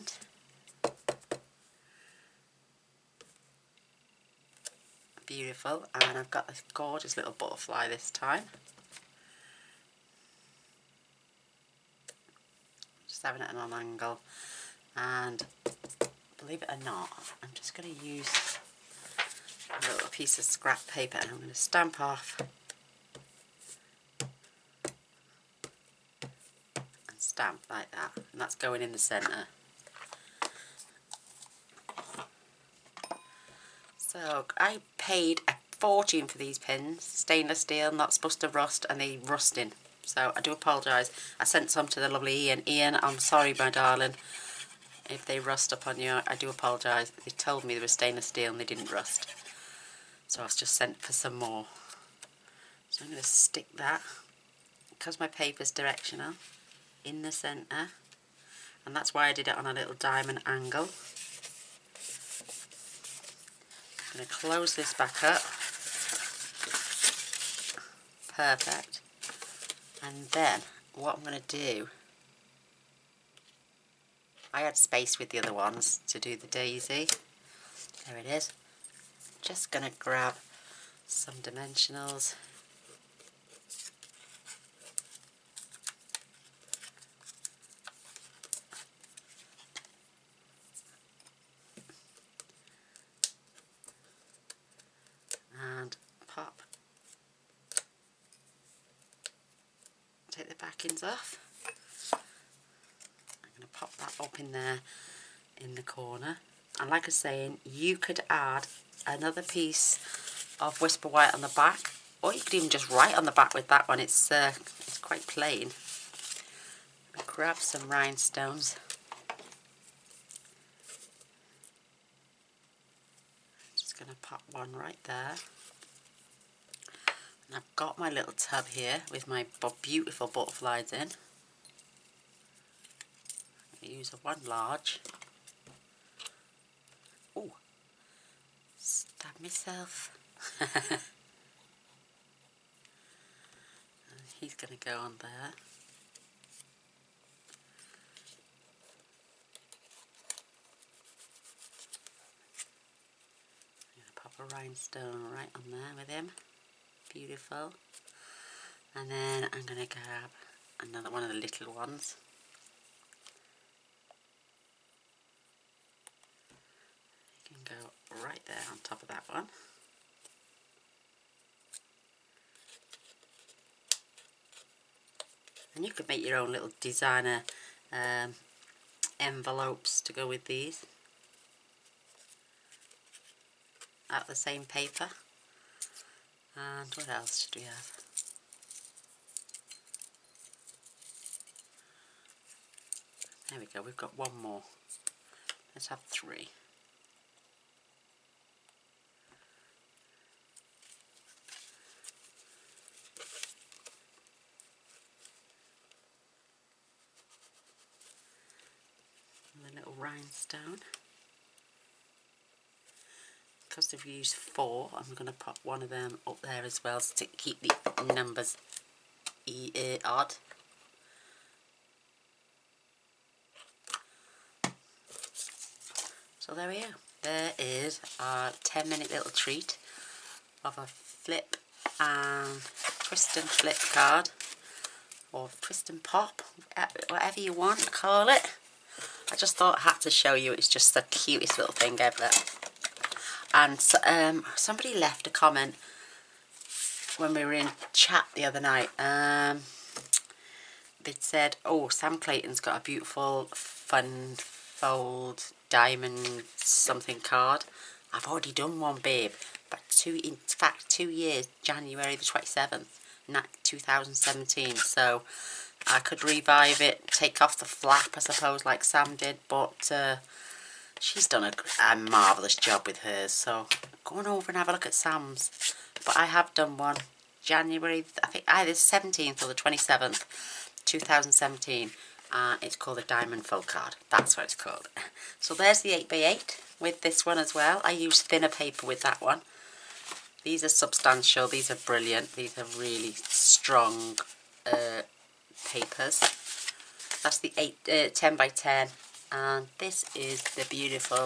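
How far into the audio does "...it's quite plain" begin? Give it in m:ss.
1:54.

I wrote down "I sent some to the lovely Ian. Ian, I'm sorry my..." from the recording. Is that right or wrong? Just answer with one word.
right.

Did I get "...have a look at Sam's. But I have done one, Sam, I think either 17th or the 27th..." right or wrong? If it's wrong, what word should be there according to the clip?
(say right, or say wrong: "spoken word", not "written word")
wrong: "January", not "Sam".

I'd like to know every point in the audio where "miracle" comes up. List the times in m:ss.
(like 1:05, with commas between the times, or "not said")
not said.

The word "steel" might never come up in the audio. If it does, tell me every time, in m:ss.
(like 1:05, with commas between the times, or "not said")
0:37, 0:48.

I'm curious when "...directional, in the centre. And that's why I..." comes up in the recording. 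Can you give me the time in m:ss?
0:55.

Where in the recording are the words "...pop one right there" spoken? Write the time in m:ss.
2:04.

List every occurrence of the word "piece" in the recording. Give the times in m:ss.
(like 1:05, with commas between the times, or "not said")
0:20, 1:49.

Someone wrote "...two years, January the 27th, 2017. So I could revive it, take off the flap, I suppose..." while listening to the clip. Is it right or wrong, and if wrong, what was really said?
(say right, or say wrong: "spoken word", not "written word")
right.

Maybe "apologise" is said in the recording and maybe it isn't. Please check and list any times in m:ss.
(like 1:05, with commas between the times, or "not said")
0:40, 0:46.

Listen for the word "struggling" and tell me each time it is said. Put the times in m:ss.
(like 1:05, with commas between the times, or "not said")
not said.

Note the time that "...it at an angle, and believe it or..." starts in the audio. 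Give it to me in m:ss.
0:13.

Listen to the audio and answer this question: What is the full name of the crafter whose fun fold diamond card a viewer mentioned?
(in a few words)
Sam Clayton.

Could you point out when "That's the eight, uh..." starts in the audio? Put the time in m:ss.
4:57.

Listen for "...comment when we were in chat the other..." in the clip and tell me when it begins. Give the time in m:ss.
4:05.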